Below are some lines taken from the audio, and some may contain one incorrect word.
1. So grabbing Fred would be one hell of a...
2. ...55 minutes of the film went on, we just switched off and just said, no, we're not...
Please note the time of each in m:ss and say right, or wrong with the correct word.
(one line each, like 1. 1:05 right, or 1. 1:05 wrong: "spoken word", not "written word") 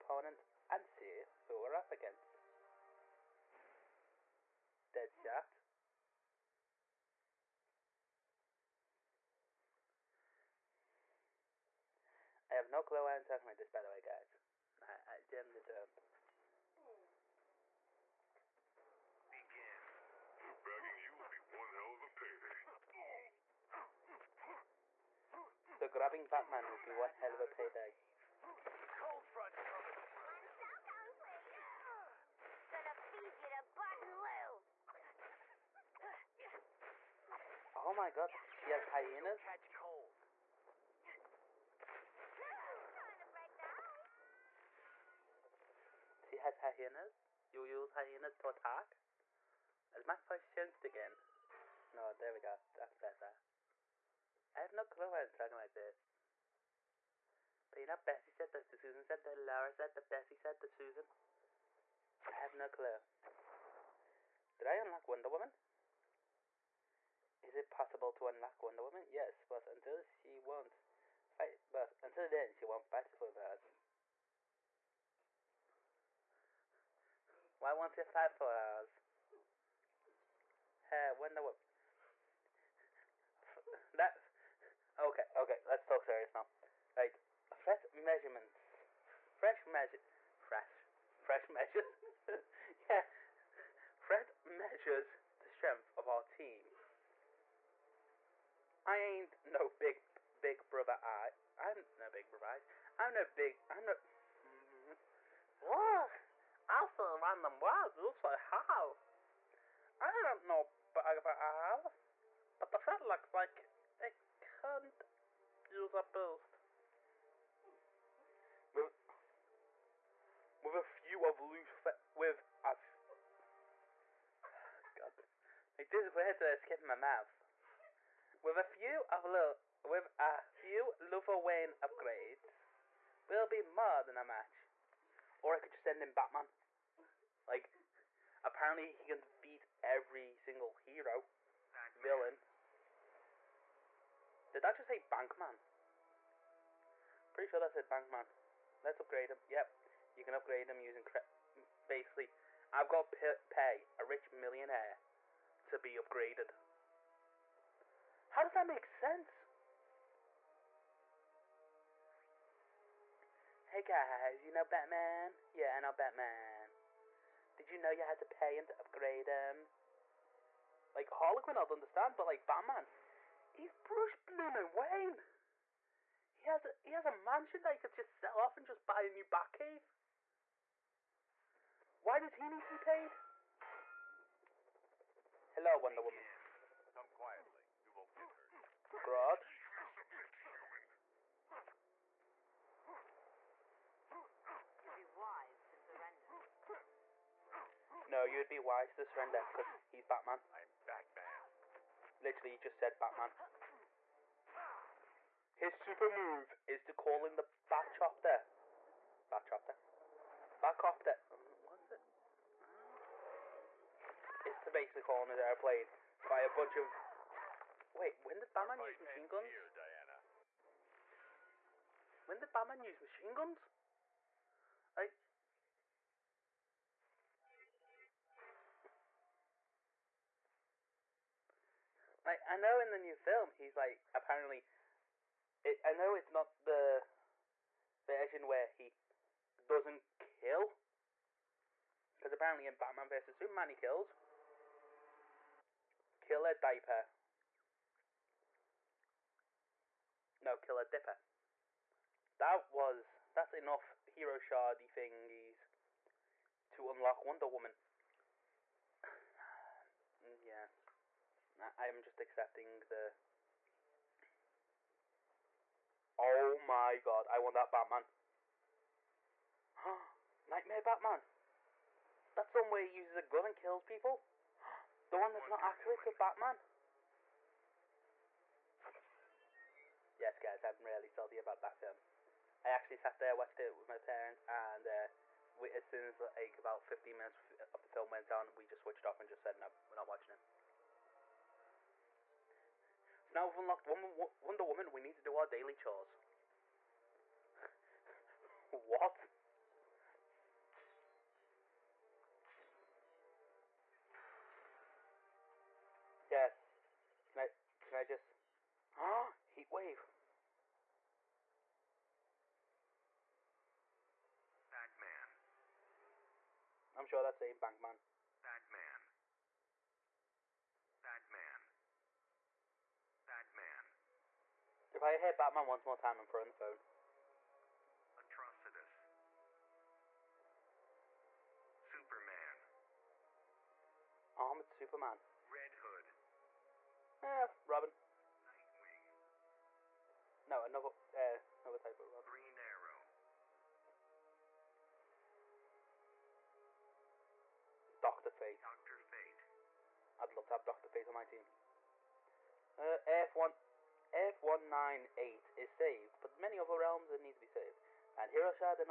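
1. 0:25 wrong: "Batman", not "Fred"
2. 4:46 wrong: "15", not "55".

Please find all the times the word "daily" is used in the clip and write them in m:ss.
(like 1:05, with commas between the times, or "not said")
4:55.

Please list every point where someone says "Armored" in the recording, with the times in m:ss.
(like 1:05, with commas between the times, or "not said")
5:34.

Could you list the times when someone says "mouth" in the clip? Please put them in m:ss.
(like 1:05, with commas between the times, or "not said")
2:06.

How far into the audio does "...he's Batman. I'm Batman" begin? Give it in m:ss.
3:19.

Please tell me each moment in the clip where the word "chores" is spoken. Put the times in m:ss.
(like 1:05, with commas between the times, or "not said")
4:55.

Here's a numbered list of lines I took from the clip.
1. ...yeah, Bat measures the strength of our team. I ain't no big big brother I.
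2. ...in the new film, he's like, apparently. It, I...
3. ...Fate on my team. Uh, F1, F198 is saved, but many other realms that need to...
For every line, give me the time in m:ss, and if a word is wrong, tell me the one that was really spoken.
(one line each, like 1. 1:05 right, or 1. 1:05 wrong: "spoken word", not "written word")
1. 1:32 wrong: "Fred", not "Bat"
2. 3:52 right
3. 5:50 right.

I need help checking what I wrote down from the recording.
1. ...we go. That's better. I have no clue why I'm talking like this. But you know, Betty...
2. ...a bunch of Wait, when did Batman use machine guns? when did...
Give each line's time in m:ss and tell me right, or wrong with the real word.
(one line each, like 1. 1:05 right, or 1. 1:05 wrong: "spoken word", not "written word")
1. 0:52 right
2. 3:36 right.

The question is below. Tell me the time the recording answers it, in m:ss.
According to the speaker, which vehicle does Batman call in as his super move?
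3:26.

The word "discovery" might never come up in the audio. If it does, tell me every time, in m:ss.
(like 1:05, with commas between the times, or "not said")
not said.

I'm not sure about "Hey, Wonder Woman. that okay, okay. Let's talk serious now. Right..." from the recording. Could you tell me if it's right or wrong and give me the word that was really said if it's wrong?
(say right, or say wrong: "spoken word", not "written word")
right.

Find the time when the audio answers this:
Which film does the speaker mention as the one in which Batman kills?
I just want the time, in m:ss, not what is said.
4:02.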